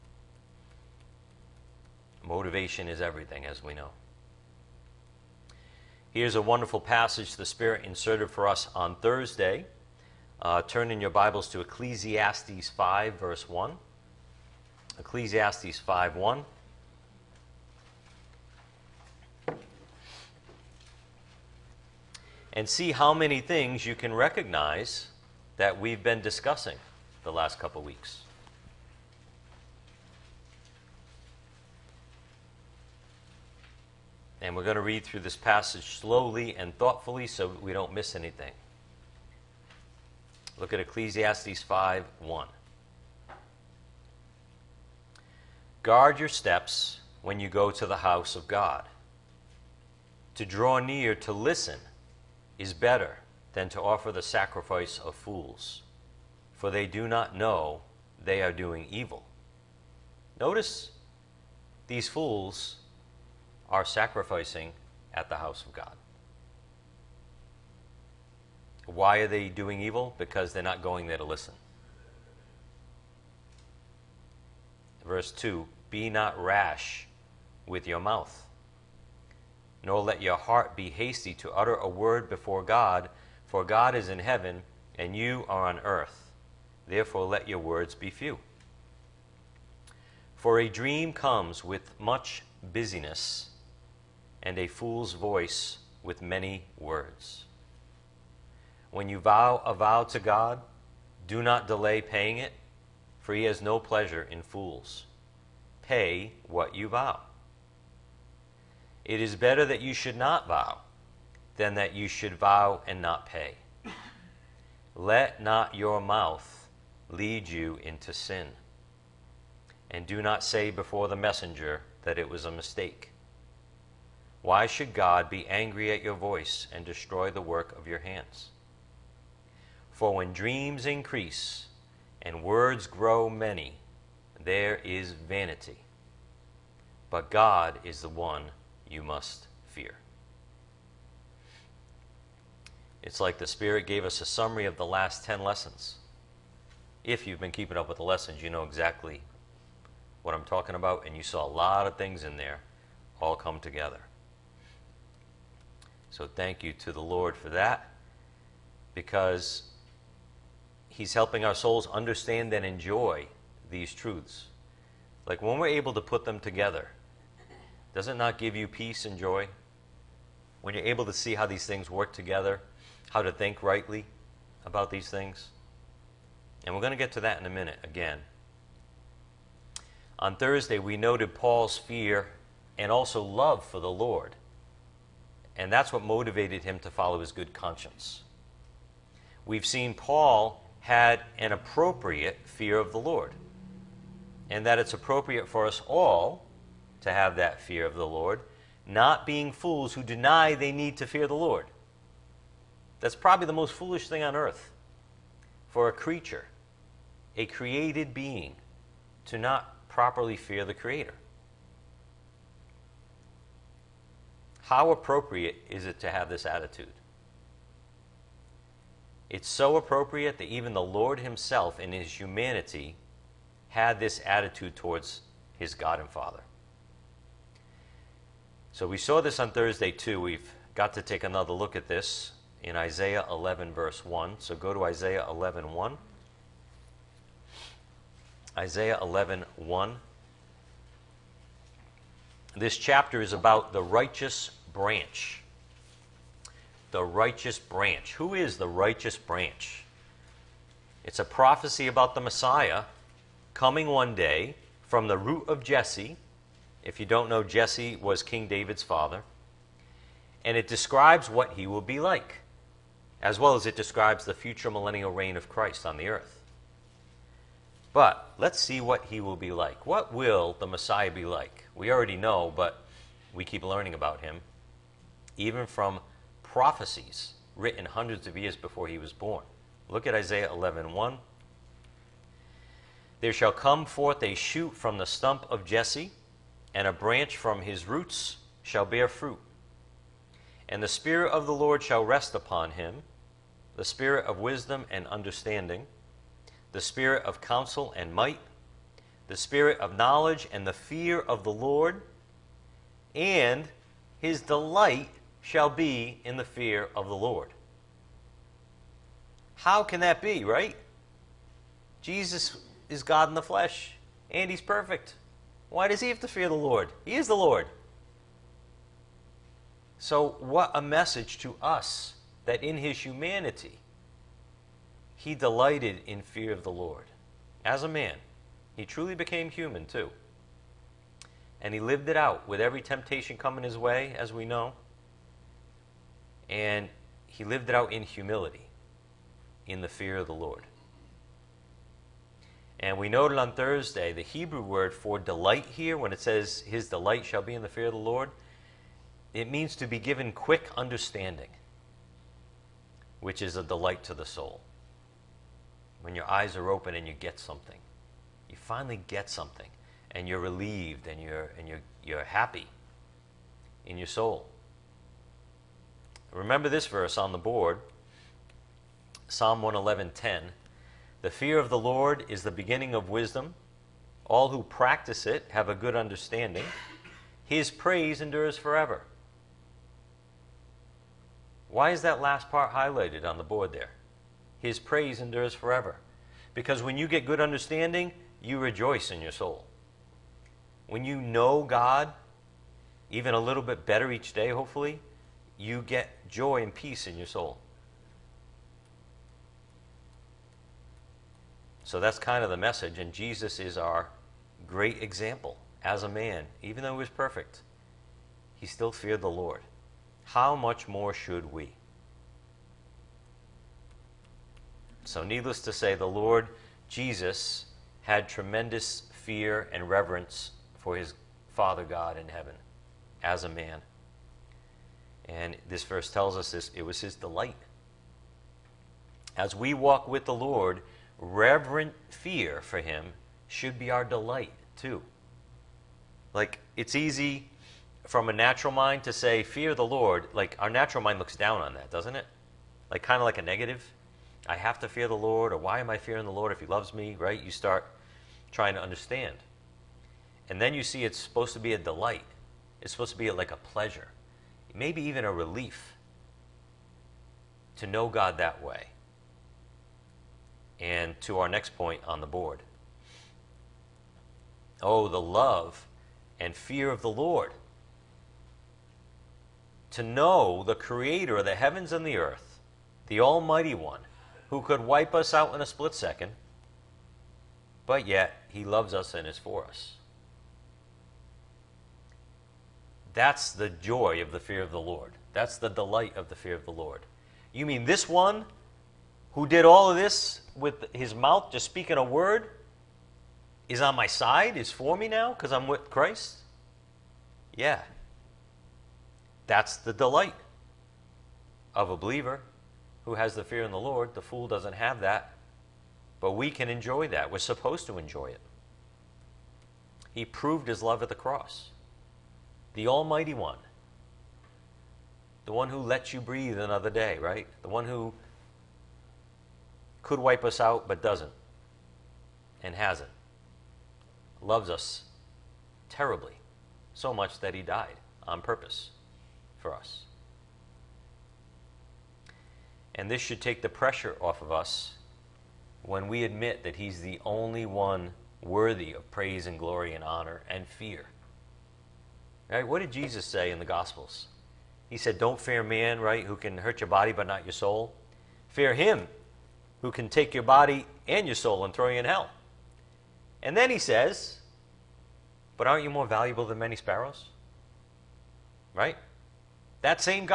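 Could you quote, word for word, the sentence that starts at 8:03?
That's the joy of the fear of the Lord.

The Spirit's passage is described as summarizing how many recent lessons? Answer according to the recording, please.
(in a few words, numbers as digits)
10.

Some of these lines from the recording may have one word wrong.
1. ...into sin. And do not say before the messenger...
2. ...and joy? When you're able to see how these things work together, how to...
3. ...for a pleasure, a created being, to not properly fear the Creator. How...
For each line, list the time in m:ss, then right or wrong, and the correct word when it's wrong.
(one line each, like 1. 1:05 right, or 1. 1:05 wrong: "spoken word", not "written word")
1. 1:57 right
2. 2:49 right
3. 3:25 wrong: "creature", not "pleasure".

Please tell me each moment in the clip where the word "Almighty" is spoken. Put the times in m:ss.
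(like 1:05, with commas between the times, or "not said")
7:53, 8:32.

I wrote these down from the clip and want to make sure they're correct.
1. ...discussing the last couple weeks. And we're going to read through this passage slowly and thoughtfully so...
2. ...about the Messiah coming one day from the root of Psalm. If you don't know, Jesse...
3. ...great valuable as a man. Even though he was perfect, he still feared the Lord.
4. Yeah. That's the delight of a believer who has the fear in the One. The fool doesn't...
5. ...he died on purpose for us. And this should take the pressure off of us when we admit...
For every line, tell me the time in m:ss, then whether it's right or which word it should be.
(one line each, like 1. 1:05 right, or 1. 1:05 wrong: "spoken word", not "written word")
1. 0:26 right
2. 4:11 wrong: "Jesse", not "Psalm"
3. 6:44 wrong: "example", not "valuable"
4. 8:17 wrong: "Lord", not "One"
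5. 8:47 right.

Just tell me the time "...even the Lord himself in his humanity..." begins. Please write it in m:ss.
3:40.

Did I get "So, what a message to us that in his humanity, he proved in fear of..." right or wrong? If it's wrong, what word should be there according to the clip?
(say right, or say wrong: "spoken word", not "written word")
wrong: "delighted", not "proved".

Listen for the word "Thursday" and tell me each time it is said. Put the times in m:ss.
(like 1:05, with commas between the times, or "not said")
0:08, 3:00, 3:49, 5:43.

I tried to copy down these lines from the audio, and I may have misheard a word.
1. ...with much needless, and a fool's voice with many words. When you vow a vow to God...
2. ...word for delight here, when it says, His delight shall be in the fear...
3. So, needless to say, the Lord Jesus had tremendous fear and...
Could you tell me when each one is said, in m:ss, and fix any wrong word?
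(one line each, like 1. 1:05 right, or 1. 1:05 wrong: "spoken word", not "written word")
1. 1:31 wrong: "busyness", not "needless"
2. 5:44 right
3. 6:55 right.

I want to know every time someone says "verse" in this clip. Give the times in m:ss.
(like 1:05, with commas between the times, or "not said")
0:13, 1:15, 3:53, 6:06, 7:05.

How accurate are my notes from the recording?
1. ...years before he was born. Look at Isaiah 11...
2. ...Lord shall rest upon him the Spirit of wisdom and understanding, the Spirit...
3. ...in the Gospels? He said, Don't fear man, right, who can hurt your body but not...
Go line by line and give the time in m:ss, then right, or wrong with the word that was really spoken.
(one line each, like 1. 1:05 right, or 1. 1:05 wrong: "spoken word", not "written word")
1. 4:38 right
2. 4:51 right
3. 9:03 right.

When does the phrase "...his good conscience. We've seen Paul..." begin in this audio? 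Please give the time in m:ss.
3:07.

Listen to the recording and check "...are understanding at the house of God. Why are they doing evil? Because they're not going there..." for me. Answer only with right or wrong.
wrong.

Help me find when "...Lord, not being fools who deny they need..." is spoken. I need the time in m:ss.
3:18.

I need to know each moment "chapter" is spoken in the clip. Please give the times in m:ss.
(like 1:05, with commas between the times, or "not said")
4:02.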